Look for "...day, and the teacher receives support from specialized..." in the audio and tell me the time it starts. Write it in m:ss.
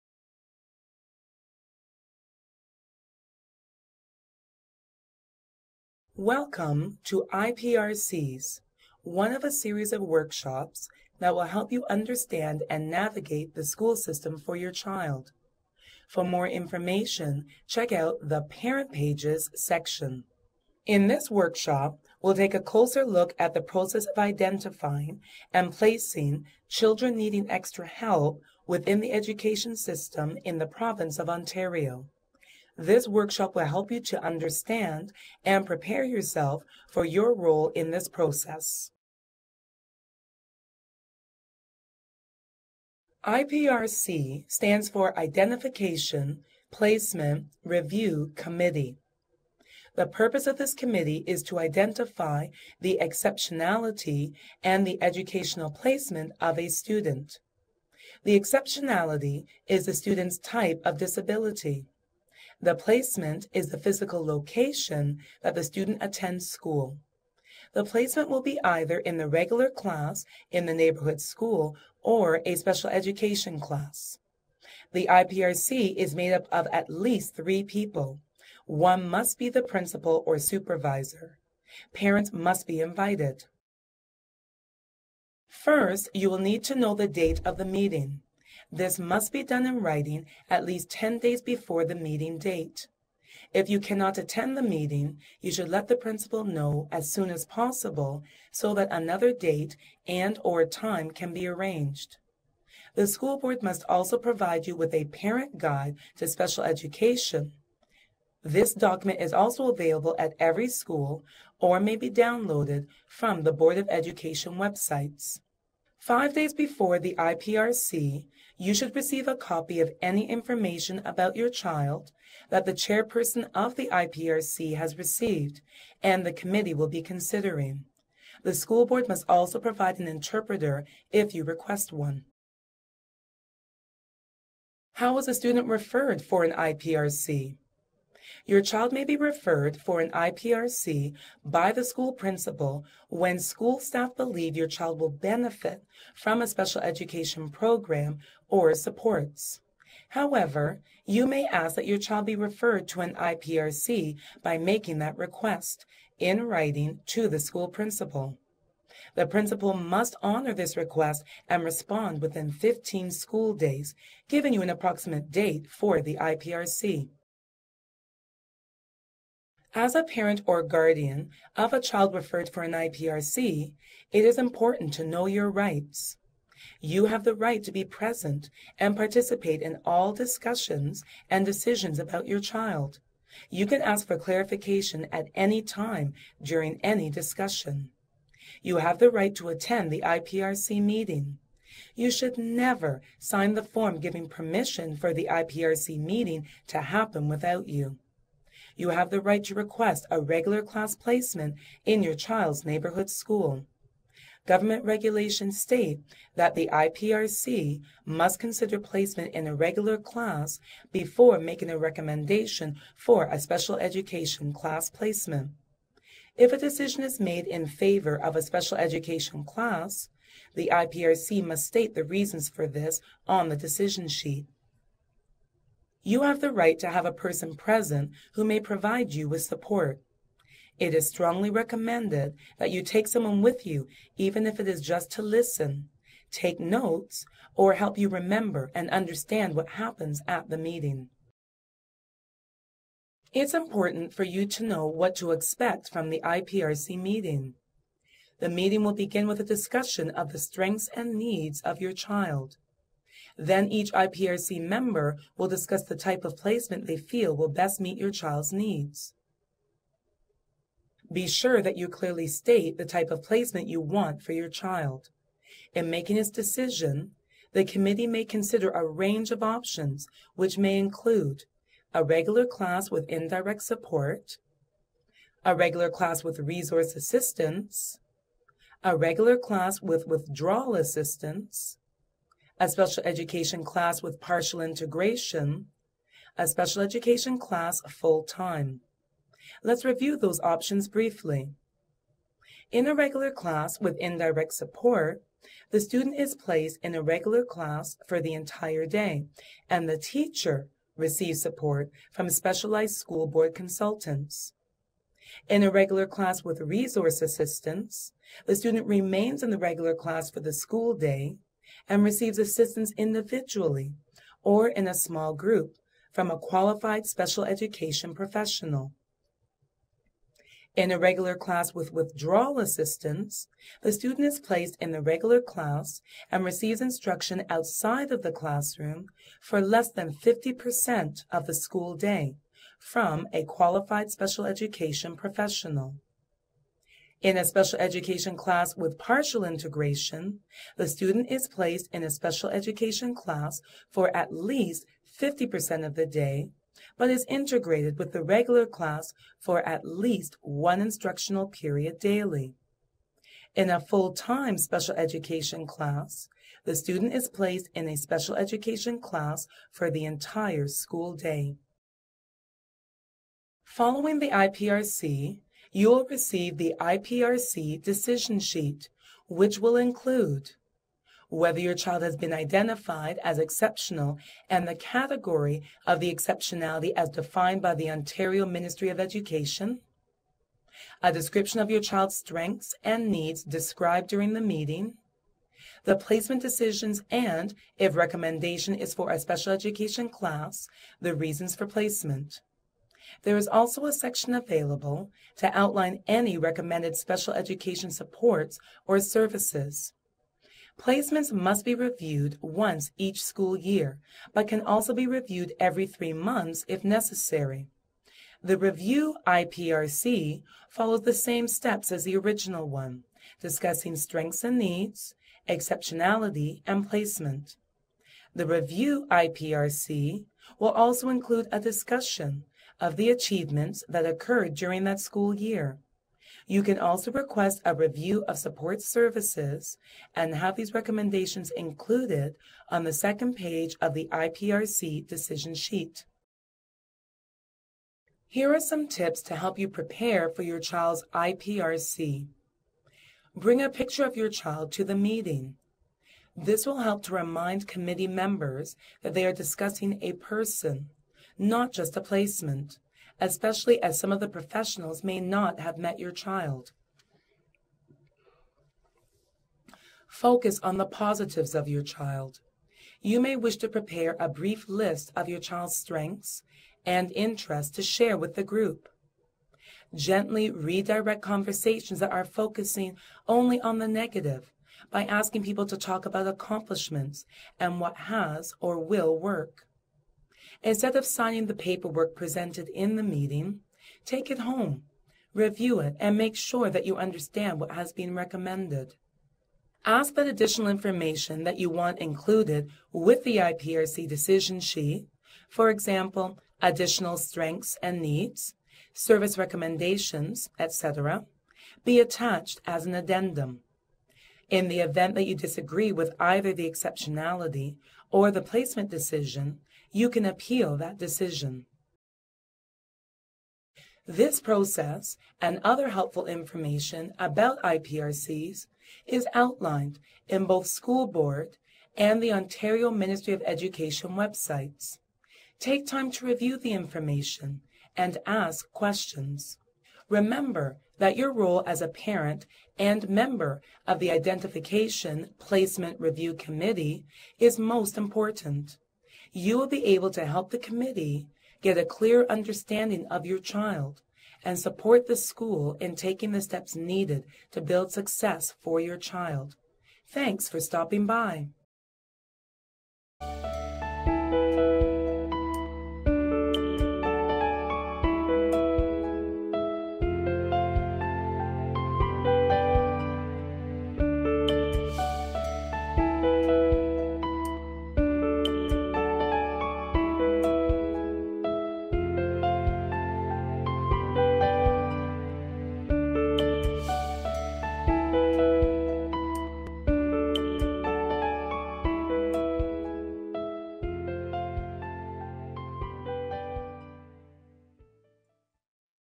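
4:58.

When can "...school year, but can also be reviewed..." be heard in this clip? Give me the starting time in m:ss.
6:43.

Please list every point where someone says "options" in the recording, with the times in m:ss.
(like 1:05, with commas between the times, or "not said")
4:29, 4:50.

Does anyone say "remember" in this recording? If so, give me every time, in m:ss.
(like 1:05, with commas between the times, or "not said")
3:58, 8:50.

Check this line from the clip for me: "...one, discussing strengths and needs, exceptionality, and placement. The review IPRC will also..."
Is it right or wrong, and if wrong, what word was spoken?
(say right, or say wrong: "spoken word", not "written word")
right.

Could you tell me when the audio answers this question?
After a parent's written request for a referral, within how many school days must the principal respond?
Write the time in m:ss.
2:42.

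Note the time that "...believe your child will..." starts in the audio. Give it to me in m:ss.
2:24.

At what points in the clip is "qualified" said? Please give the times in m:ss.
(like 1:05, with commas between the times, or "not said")
5:16, 5:33.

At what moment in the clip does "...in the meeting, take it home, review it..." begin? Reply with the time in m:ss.
8:02.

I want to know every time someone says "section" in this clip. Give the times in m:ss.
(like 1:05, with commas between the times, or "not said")
0:19, 6:33.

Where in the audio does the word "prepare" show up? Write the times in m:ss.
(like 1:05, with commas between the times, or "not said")
0:35, 7:19, 7:43.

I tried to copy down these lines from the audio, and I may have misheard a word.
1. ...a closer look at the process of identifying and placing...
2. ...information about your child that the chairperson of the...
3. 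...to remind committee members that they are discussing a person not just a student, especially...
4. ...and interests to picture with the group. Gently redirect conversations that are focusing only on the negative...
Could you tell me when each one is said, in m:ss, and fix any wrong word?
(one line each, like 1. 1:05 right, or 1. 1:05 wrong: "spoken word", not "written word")
1. 0:22 right
2. 2:00 right
3. 7:27 wrong: "placement", not "student"
4. 7:46 wrong: "share", not "picture".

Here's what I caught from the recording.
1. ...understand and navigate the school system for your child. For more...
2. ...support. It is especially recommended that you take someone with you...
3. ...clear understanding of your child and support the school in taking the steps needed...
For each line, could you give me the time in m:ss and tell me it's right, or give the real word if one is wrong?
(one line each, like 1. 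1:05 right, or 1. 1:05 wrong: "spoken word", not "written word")
1. 0:11 right
2. 3:49 wrong: "strongly", not "especially"
3. 9:01 right.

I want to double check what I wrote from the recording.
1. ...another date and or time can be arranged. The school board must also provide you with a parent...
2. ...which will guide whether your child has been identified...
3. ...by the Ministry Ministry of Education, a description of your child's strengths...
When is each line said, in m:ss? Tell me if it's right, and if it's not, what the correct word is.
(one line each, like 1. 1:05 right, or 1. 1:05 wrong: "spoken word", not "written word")
1. 1:38 right
2. 6:09 wrong: "include", not "guide"
3. 6:17 wrong: "Ontario", not "Ministry".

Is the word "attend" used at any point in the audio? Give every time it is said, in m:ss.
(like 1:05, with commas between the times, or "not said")
1:06, 1:34, 3:09.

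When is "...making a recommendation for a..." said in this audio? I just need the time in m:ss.
3:31.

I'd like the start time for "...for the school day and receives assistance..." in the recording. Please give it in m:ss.
5:10.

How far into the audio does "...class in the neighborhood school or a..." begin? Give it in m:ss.
1:09.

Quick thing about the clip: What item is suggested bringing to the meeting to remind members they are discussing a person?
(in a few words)
A picture of your child.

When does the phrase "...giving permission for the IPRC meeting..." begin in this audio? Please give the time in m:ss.
3:14.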